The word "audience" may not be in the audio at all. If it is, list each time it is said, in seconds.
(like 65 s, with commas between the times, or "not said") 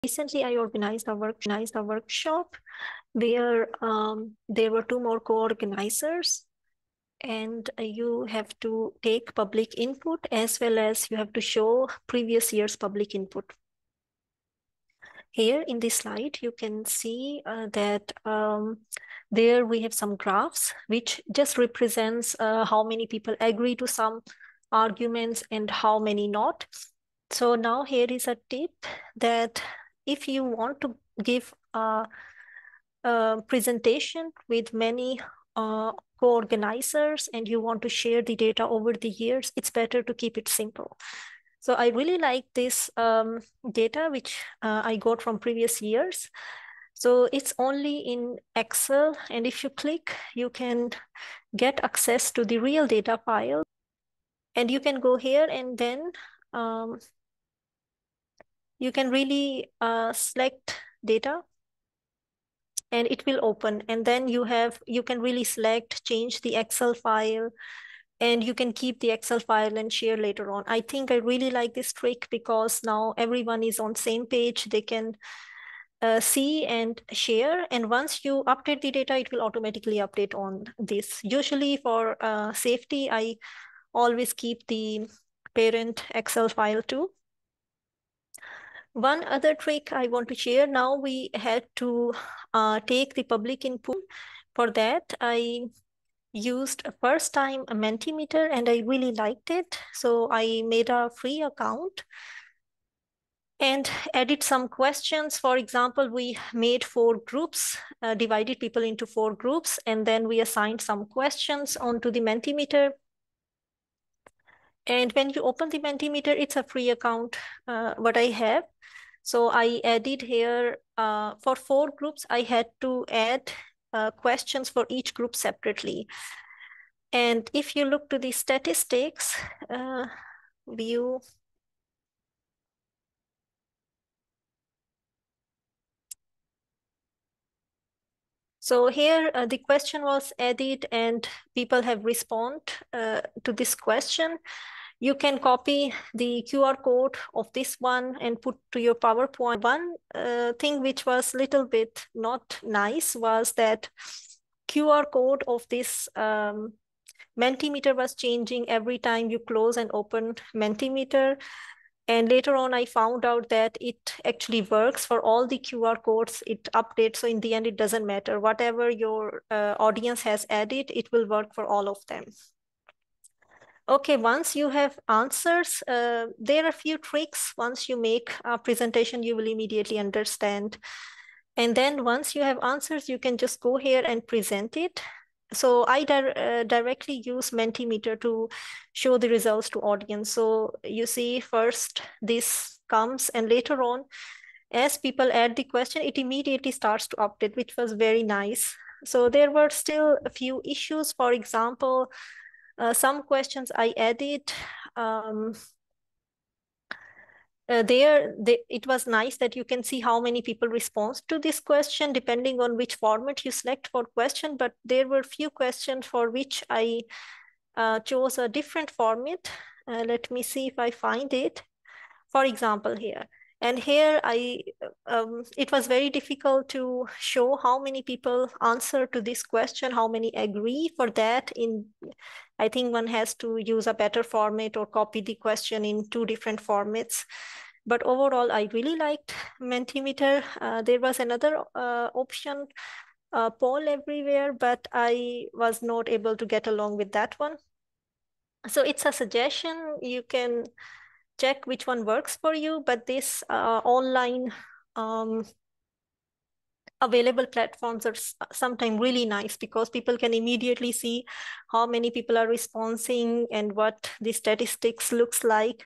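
169 s, 189 s.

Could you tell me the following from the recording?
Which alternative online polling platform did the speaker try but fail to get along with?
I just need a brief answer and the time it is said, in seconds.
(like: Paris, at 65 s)
Poll Everywhere, at 243 s.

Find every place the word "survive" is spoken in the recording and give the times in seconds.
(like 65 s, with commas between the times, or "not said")
not said.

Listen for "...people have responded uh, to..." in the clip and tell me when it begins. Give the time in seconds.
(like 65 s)
141 s.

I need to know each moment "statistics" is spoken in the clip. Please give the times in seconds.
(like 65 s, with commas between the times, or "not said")
128 s, 264 s.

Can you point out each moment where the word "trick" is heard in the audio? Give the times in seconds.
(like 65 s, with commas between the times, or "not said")
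72 s, 89 s, 176 s.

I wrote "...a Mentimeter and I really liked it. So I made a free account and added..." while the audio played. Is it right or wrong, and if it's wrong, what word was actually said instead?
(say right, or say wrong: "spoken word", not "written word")
right.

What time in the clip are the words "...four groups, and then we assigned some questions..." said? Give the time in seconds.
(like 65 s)
109 s.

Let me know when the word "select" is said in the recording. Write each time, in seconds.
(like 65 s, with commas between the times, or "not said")
60 s, 65 s, 213 s.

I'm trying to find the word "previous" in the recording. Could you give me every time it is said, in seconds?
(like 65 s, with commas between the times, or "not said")
12 s, 45 s.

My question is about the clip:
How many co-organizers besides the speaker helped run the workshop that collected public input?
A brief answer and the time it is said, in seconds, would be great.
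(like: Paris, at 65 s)
2, at 4 s.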